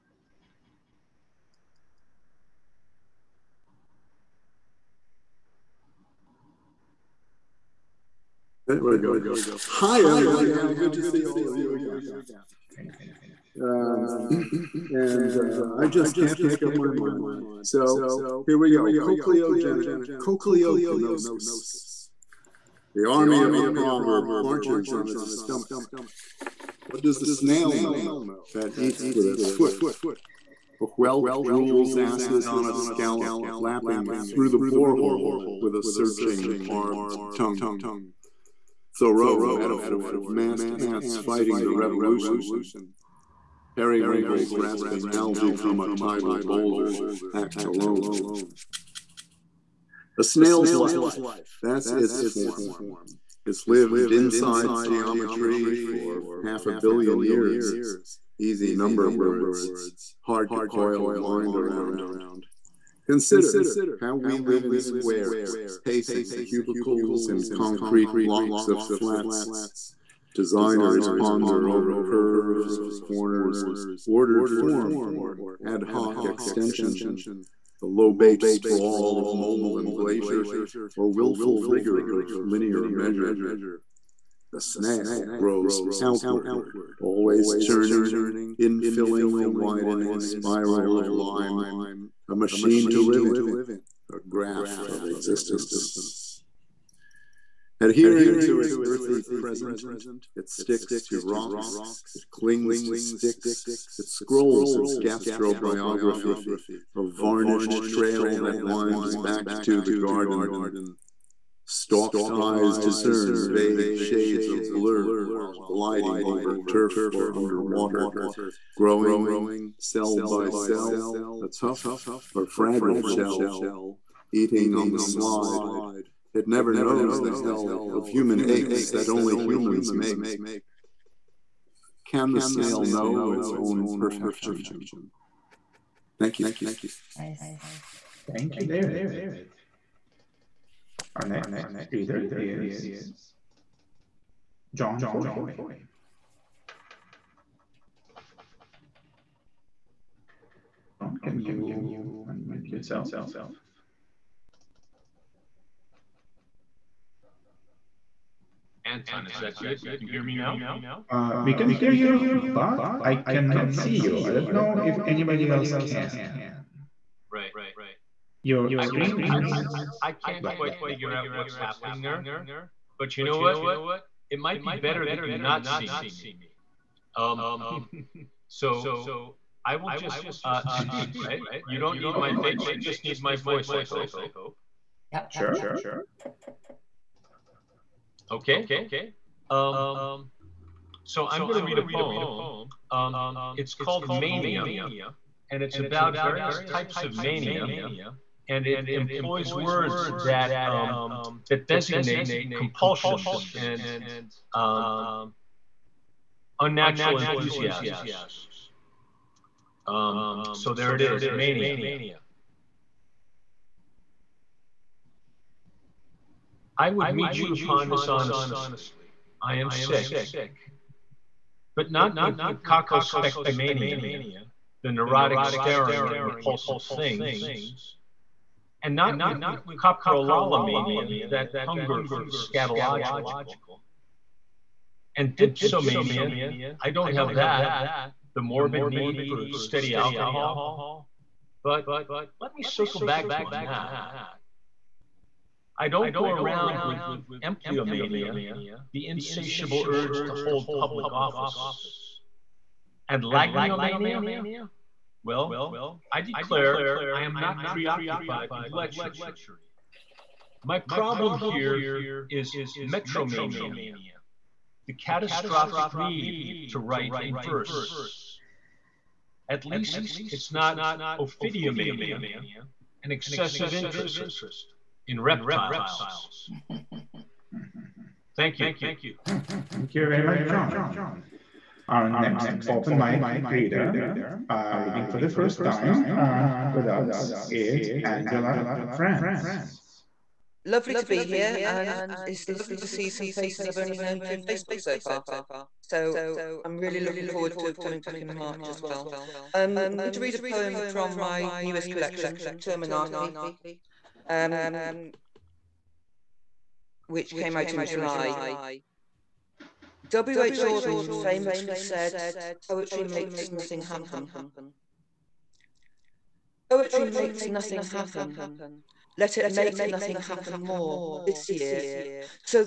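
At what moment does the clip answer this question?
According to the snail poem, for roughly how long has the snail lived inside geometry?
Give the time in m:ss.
0:56.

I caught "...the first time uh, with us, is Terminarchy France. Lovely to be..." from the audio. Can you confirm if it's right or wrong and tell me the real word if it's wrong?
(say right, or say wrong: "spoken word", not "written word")
wrong: "Angela", not "Terminarchy".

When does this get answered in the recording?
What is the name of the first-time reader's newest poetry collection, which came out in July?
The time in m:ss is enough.
5:02.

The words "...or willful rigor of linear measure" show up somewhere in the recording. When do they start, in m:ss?
1:20.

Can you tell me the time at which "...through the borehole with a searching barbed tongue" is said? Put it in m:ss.
0:34.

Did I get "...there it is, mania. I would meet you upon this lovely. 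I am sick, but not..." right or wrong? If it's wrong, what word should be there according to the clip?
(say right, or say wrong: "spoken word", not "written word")
wrong: "honestly", not "lovely".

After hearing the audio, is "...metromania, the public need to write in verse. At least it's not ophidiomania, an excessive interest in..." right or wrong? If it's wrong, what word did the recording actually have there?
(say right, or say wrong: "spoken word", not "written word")
wrong: "catastrophic", not "public".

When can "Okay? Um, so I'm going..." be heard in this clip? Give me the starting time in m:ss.
3:08.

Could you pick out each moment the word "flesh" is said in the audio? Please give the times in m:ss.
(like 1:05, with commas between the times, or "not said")
not said.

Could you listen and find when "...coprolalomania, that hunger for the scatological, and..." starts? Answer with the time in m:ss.
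3:49.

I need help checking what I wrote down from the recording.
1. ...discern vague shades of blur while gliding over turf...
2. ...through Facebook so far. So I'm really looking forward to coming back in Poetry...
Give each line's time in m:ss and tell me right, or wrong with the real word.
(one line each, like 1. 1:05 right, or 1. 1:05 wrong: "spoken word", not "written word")
1. 1:52 right
2. 4:54 wrong: "March", not "Poetry".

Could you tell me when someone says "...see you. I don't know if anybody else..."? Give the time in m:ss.
2:43.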